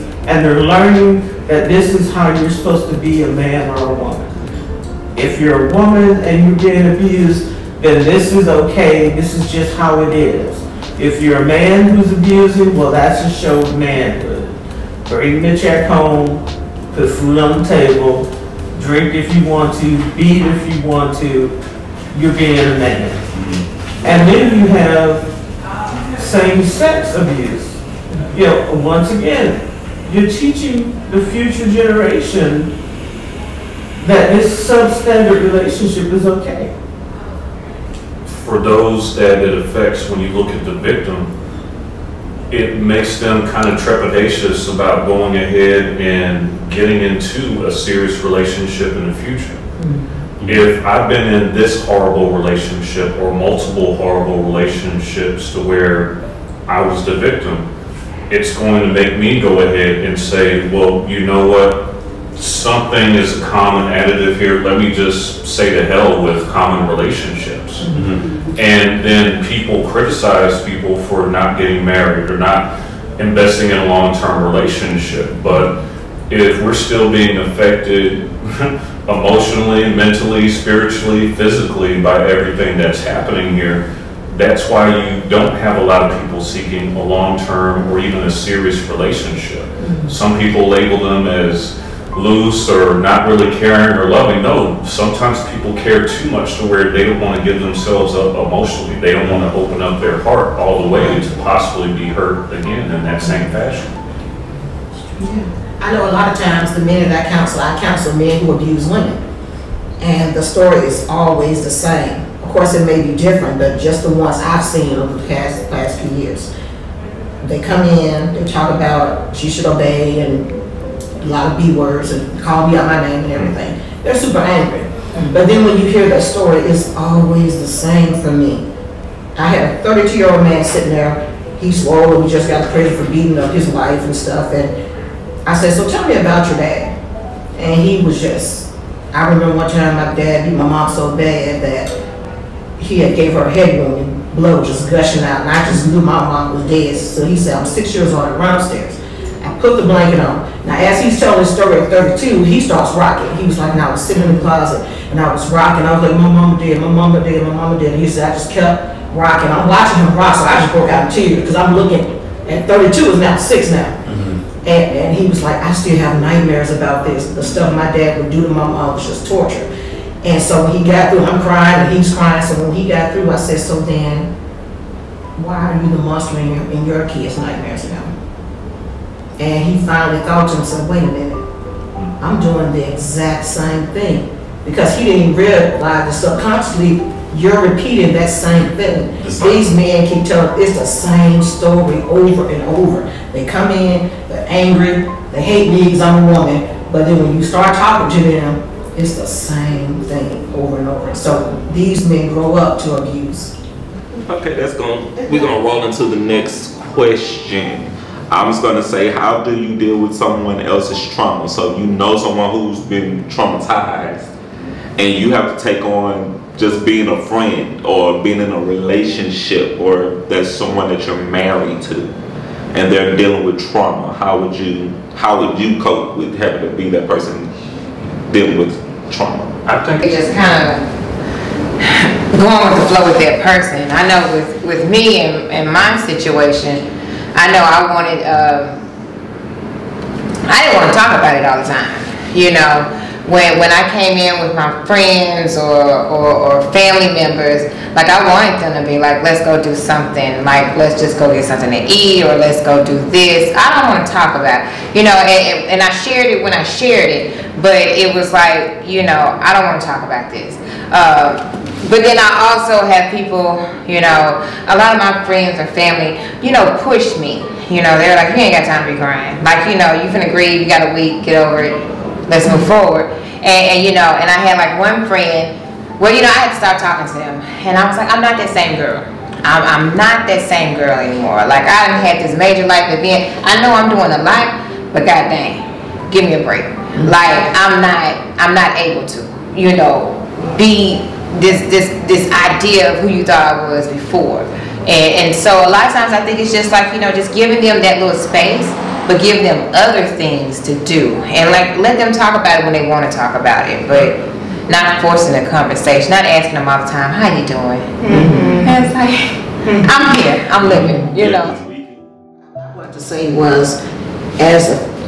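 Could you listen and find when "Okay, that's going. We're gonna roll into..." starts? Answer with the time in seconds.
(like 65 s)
204 s.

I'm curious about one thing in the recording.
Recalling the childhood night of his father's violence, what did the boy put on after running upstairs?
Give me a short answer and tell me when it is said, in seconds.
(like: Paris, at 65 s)
The blanket, at 149 s.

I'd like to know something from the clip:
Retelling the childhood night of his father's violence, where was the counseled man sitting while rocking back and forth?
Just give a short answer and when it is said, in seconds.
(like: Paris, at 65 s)
The closet, at 154 s.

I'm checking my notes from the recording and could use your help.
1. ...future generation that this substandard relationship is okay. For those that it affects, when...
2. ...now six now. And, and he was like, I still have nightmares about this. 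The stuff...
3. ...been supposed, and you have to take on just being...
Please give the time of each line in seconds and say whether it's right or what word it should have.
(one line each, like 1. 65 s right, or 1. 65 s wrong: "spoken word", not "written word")
1. 31 s right
2. 163 s right
3. 212 s wrong: "traumatized", not "supposed".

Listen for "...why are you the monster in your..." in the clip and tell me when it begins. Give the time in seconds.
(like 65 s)
175 s.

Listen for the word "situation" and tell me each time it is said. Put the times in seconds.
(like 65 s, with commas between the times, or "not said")
236 s.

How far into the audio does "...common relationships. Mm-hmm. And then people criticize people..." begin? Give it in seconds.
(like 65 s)
66 s.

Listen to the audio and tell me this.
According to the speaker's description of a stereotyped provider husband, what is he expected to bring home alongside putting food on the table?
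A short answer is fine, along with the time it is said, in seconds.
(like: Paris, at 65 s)
The check, at 15 s.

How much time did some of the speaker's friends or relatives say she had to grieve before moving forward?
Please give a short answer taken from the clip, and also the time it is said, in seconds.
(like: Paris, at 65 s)
A week, at 270 s.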